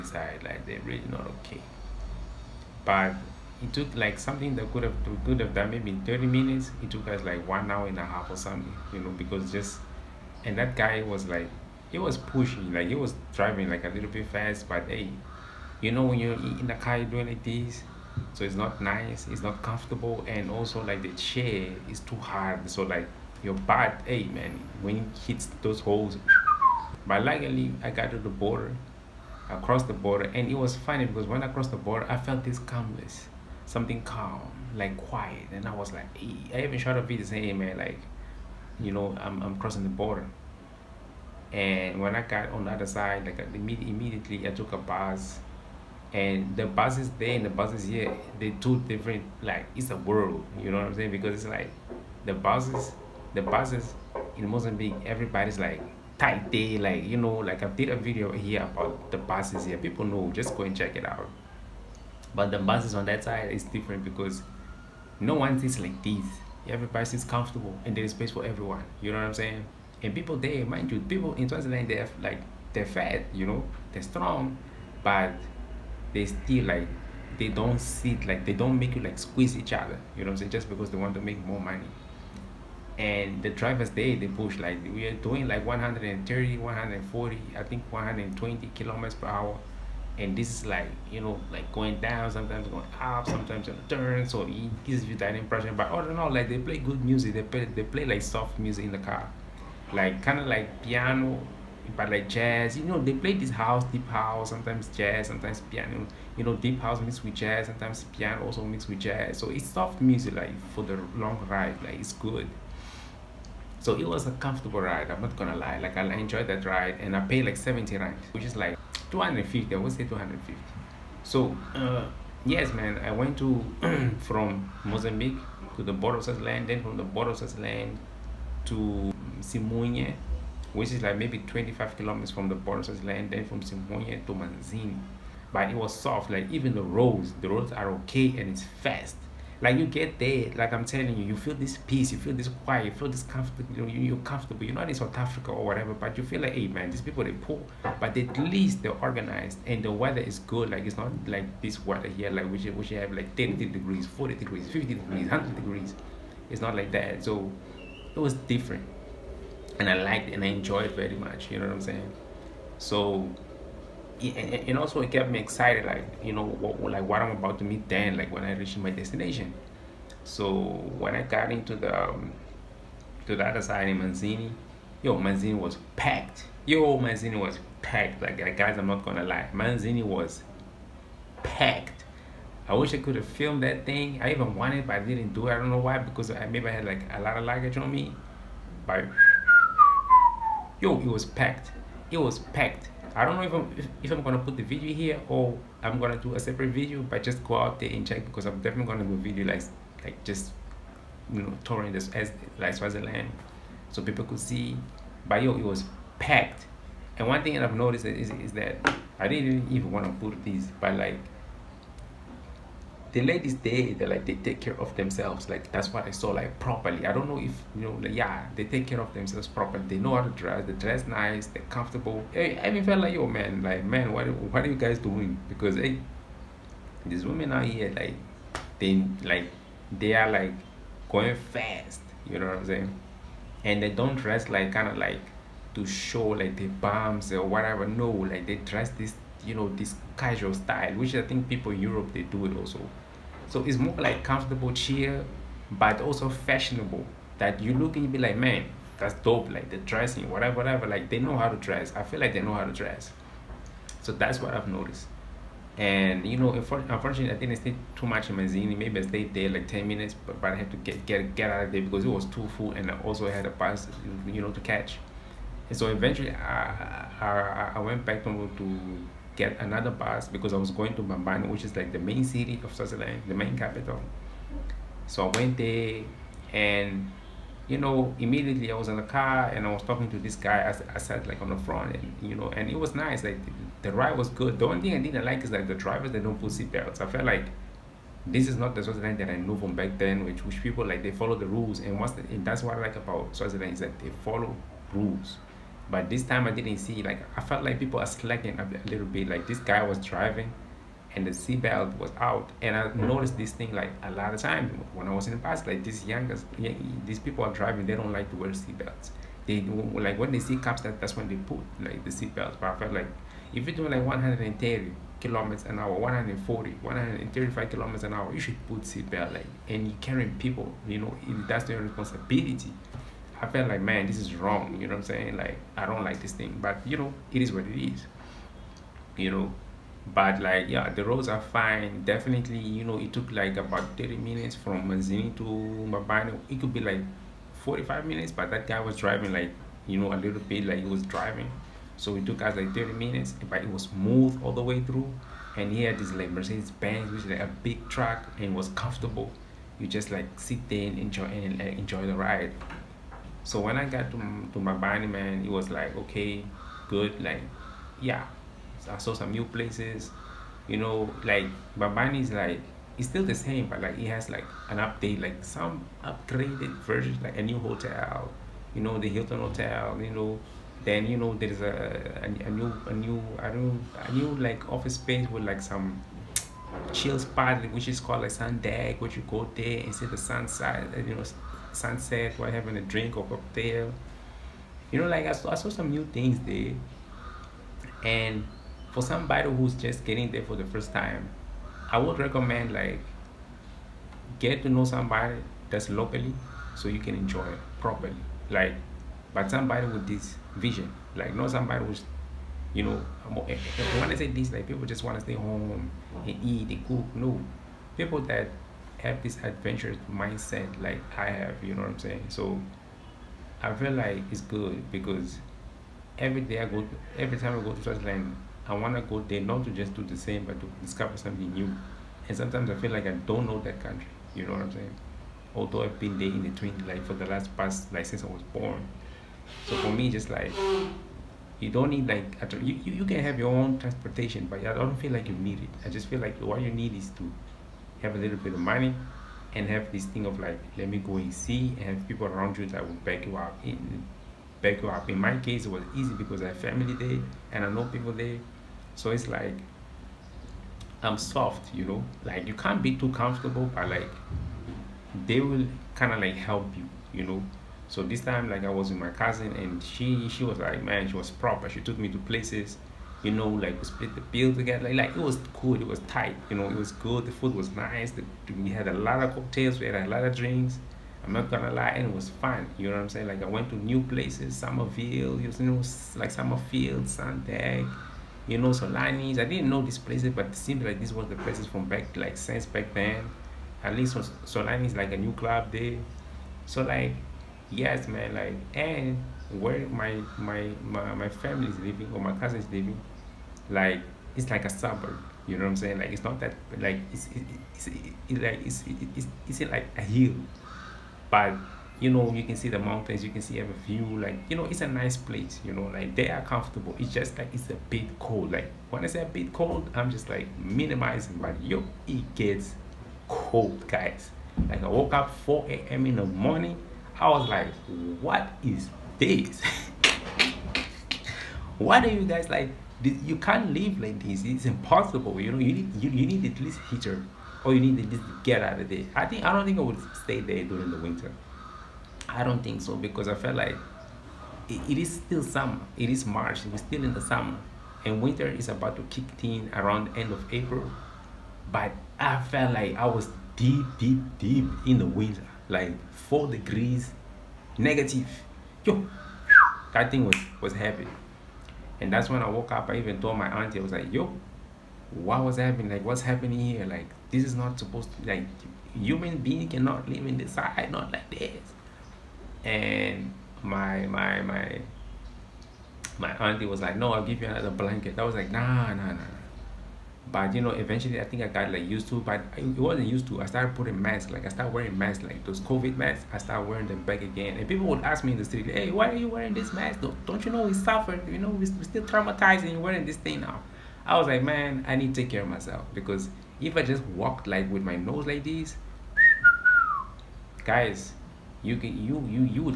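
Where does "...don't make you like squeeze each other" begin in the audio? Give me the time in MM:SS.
01:18.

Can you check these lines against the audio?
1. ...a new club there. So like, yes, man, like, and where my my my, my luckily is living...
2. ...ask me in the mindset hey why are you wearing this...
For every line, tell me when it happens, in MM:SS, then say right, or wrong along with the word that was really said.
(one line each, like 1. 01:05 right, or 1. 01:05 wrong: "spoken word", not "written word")
1. 08:05 wrong: "family", not "luckily"
2. 09:38 wrong: "street", not "mindset".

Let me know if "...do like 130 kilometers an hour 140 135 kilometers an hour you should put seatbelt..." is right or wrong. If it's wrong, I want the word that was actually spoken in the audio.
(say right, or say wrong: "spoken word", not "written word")
right.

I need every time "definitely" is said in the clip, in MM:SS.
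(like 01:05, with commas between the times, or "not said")
03:18, 05:32.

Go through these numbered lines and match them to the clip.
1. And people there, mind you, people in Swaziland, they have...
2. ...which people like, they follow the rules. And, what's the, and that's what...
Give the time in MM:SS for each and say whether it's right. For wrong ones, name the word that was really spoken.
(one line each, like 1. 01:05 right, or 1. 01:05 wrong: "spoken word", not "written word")
1. 01:10 right
2. 04:50 right.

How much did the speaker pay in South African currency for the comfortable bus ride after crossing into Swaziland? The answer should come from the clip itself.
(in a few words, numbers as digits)
70 rand.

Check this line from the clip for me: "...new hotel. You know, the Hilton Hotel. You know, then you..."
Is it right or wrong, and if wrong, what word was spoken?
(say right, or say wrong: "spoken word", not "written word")
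right.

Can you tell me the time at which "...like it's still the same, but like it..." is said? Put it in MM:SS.
06:02.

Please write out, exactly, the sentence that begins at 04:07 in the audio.
That you look and you be like, man, that's dope.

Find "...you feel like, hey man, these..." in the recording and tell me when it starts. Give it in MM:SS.
02:26.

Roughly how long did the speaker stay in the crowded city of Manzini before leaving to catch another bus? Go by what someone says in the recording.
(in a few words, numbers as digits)
10 minutes.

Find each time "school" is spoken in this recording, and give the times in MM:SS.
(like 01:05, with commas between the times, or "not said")
not said.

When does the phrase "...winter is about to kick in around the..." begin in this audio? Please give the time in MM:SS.
08:58.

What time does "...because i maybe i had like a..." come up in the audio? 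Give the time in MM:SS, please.
03:05.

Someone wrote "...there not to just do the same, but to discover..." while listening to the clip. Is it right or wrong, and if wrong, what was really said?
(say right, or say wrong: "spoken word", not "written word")
right.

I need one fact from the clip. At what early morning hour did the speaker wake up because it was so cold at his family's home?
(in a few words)
4 a.m.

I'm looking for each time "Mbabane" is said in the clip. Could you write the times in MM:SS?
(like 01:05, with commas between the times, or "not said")
04:31, 05:35.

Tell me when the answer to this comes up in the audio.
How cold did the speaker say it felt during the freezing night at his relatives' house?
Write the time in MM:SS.
09:06.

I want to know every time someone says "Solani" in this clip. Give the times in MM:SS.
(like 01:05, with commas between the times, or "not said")
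07:58, 08:04.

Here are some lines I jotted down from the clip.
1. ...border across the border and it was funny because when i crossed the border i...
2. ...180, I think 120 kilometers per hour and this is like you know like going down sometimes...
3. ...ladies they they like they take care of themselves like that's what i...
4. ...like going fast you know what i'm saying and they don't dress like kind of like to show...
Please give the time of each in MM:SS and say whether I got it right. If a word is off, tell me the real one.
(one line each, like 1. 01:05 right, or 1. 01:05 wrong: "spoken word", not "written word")
1. 00:28 right
2. 01:26 wrong: "140", not "180"
3. 03:33 right
4. 03:50 right.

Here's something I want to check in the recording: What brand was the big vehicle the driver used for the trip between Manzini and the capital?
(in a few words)
Mercedes Benz.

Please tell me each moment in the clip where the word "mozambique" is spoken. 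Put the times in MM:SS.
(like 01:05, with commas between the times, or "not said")
00:54, 02:04.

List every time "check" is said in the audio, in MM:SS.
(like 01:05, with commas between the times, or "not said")
01:00, 03:18.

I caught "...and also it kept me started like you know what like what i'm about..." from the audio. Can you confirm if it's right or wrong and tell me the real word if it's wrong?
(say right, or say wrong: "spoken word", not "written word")
wrong: "excited", not "started".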